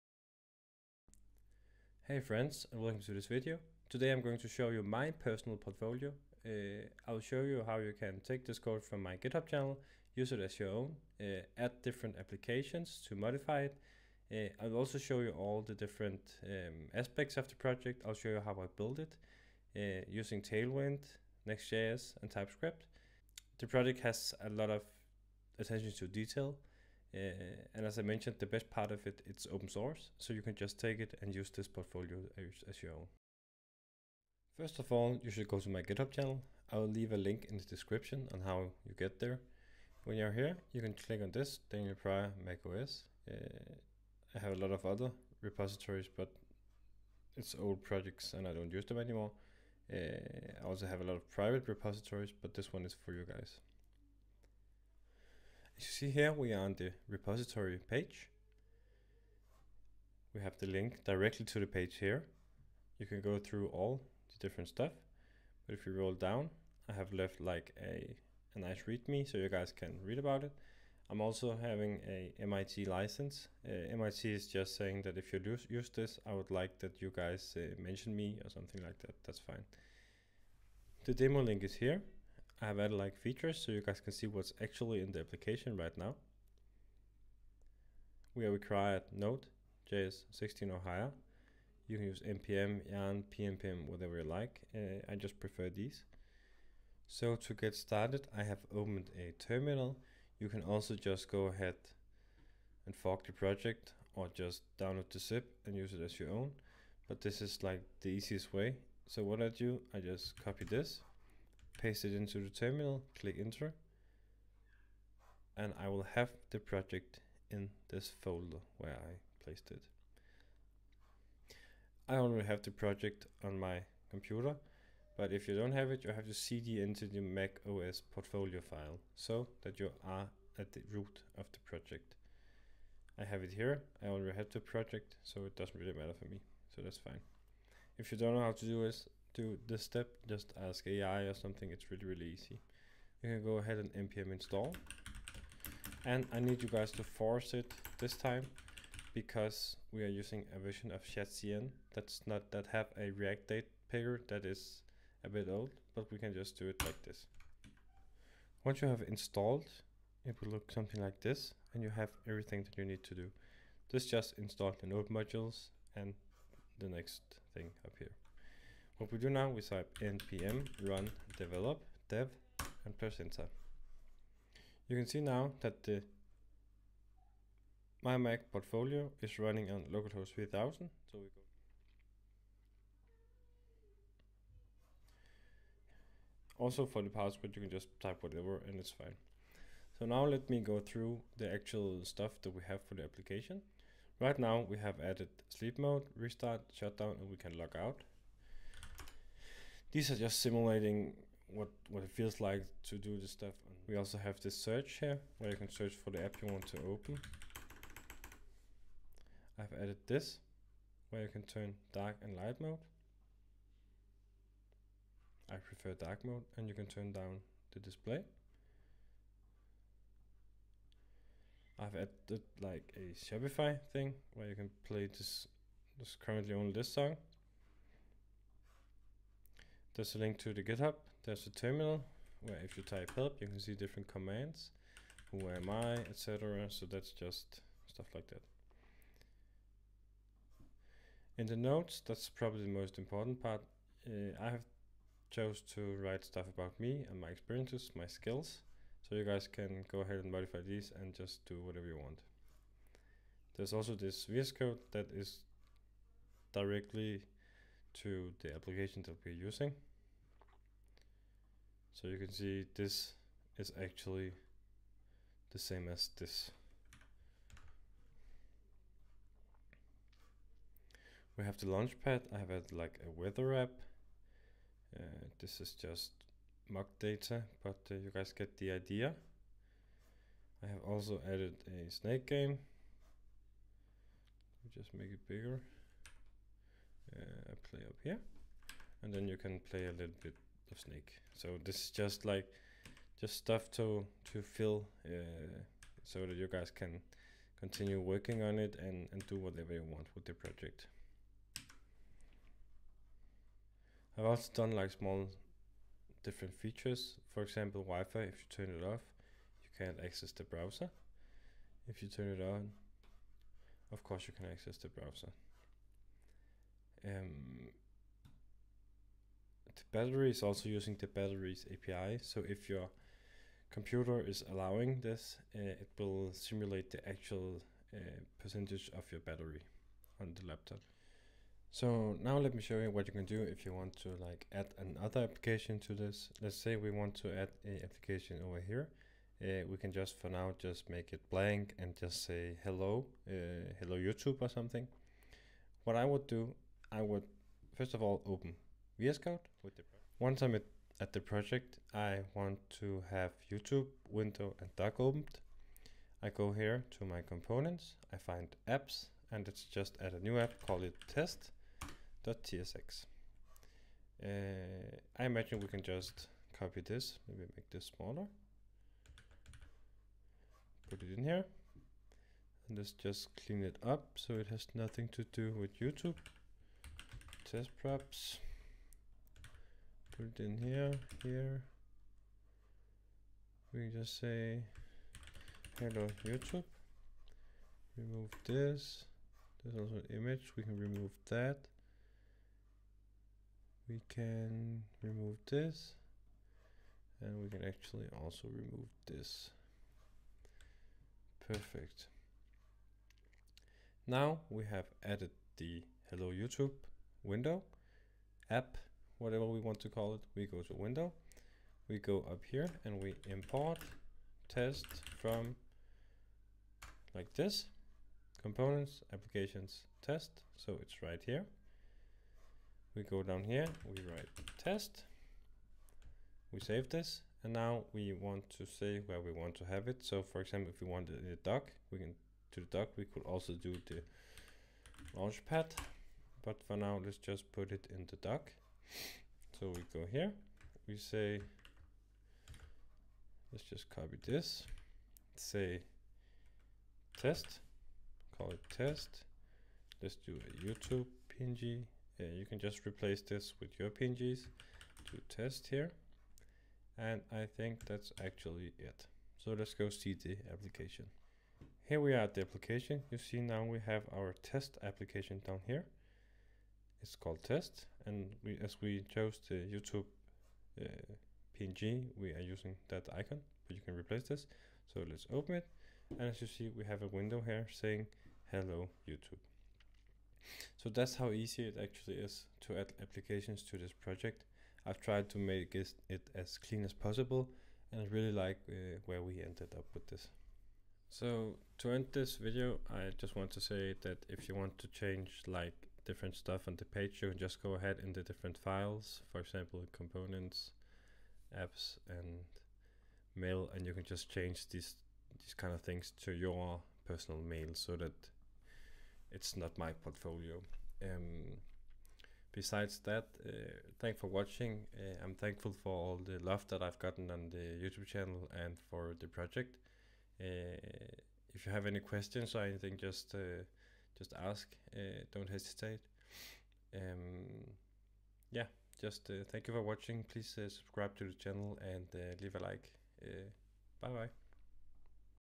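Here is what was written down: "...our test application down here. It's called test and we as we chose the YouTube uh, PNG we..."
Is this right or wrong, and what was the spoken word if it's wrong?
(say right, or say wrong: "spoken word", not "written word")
right.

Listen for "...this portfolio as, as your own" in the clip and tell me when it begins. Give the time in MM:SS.
00:31.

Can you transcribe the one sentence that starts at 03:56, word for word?
So that's just stuff like that.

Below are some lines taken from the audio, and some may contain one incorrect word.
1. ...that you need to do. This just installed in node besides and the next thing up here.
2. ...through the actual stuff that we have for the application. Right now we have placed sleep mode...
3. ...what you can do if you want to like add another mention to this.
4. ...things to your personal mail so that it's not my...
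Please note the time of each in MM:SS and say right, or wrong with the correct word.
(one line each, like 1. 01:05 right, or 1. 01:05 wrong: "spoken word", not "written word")
1. 02:42 wrong: "modules", not "besides"
2. 03:10 wrong: "added", not "placed"
3. 05:32 wrong: "application", not "mention"
4. 08:25 right.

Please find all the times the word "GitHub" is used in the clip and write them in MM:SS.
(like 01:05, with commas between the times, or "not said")
00:09, 00:35, 03:50.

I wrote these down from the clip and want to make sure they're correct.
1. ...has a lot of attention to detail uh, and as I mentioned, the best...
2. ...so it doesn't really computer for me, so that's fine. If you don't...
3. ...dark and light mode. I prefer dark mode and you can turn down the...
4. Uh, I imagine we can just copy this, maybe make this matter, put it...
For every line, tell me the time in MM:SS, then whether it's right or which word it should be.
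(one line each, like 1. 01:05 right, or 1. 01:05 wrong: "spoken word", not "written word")
1. 00:23 right
2. 02:15 wrong: "matter", not "computer"
3. 03:31 right
4. 06:04 wrong: "smaller", not "matter".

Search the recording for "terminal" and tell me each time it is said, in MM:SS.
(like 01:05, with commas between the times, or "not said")
01:39, 01:52, 03:51.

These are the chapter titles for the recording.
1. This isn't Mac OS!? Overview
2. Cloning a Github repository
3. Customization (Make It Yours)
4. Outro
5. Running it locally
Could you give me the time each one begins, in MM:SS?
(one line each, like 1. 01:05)
1. 03:02
2. 00:35
3. 05:31
4. 08:11
5. 02:25.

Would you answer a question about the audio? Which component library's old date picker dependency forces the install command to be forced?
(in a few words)
ShadCN.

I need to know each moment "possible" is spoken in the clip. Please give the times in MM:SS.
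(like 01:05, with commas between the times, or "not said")
08:06.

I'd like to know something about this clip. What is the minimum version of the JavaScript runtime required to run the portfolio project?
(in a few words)
Node.js 16.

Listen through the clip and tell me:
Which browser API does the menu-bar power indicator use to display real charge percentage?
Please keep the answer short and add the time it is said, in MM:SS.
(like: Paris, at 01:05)
Batteries API, at 05:21.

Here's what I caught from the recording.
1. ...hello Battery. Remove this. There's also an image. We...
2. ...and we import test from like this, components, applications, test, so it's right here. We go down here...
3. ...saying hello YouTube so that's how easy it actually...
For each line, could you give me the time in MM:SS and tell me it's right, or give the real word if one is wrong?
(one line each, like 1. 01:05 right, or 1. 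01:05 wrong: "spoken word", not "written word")
1. 06:25 wrong: "YouTube", not "Battery"
2. 06:52 right
3. 07:57 right.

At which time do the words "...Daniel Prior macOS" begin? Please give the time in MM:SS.
00:41.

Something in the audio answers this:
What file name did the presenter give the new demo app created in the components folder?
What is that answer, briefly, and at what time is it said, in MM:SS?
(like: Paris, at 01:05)
test.tsx, at 06:01.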